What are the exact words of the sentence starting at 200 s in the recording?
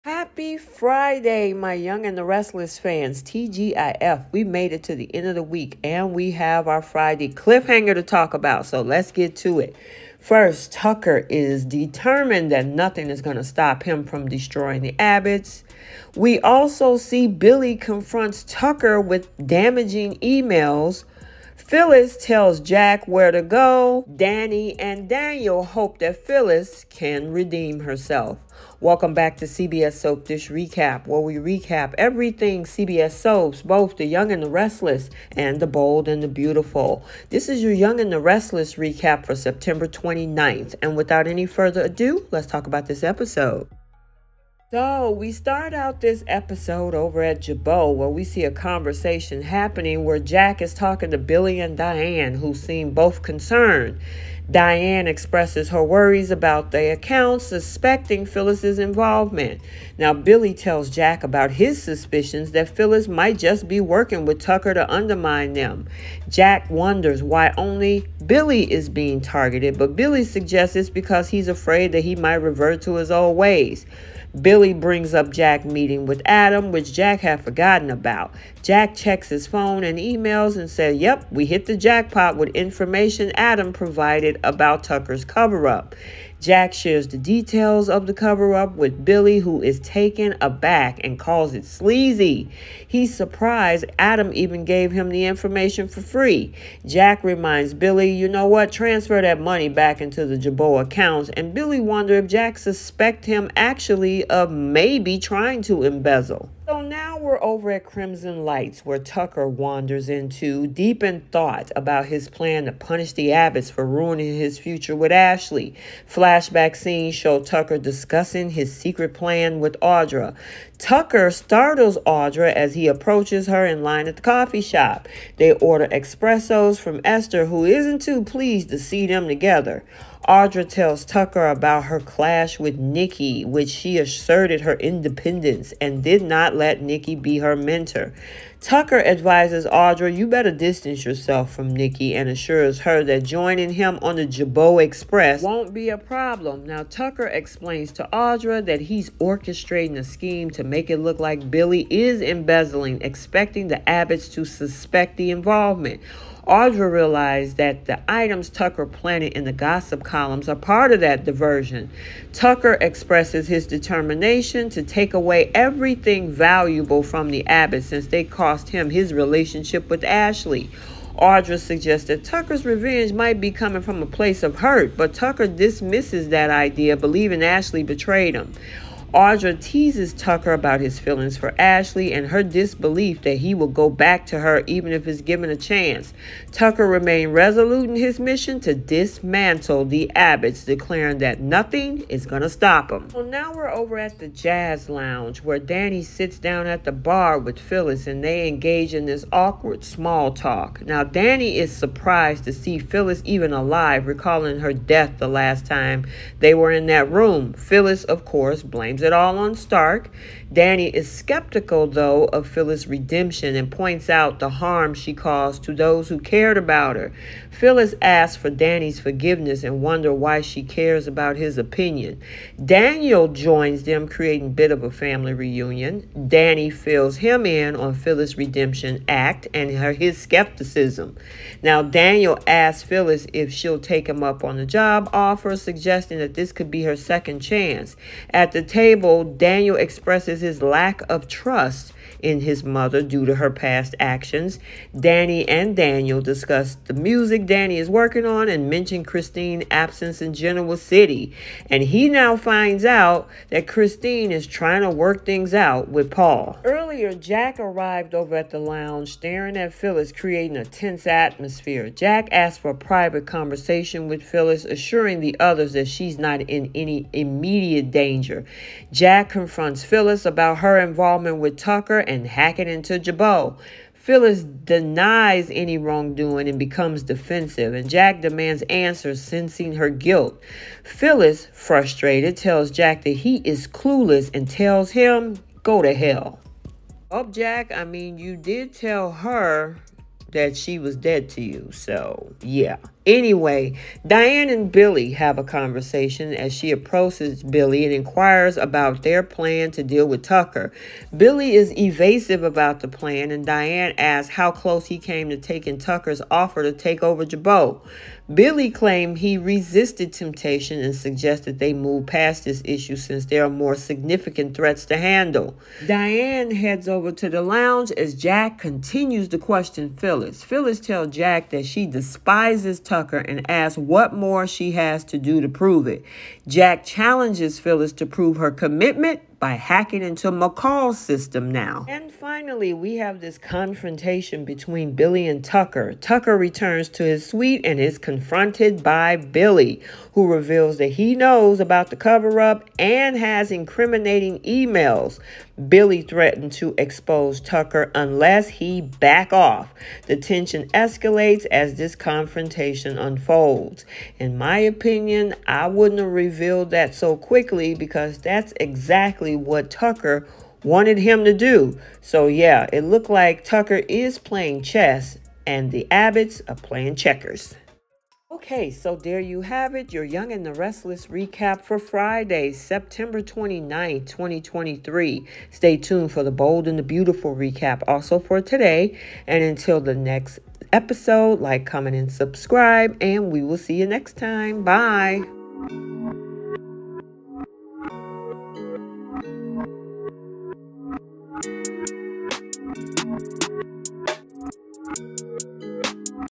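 Now, Danny is surprised to see Phyllis even alive, recalling her death the last time they were in that room.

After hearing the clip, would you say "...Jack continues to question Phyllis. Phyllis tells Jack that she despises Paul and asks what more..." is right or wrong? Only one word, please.
wrong.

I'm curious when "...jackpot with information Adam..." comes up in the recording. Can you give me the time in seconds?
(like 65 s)
81 s.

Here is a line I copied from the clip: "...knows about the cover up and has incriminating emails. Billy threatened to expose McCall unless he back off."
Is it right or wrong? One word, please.
wrong.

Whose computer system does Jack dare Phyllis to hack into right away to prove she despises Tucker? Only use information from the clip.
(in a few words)
McCall's.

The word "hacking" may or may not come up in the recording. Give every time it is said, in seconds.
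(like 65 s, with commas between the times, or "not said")
272 s, 329 s.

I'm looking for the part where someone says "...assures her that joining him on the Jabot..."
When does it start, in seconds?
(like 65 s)
142 s.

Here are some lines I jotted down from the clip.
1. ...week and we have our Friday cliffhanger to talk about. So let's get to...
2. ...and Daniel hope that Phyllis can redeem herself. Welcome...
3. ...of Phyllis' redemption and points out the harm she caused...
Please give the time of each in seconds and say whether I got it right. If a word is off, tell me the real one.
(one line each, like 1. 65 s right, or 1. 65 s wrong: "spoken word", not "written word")
1. 5 s right
2. 24 s right
3. 212 s right.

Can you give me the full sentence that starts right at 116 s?
Flashback scenes show Tucker discussing his secret plan with Audra.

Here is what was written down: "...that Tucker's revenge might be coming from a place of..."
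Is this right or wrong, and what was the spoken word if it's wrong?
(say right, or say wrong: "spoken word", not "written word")
right.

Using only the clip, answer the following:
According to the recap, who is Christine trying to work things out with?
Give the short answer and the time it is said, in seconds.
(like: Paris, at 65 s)
Paul, at 256 s.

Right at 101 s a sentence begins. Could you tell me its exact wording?
And Billy wonders if Jack suspect him actually of maybe trying to embezzle.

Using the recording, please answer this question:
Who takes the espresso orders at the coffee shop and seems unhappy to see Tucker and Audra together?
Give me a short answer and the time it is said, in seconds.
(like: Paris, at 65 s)
Esther, at 127 s.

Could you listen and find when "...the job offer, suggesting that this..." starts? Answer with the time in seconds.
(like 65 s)
234 s.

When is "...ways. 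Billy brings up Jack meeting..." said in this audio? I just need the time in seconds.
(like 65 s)
73 s.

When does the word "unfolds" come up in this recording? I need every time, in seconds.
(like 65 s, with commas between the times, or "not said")
352 s.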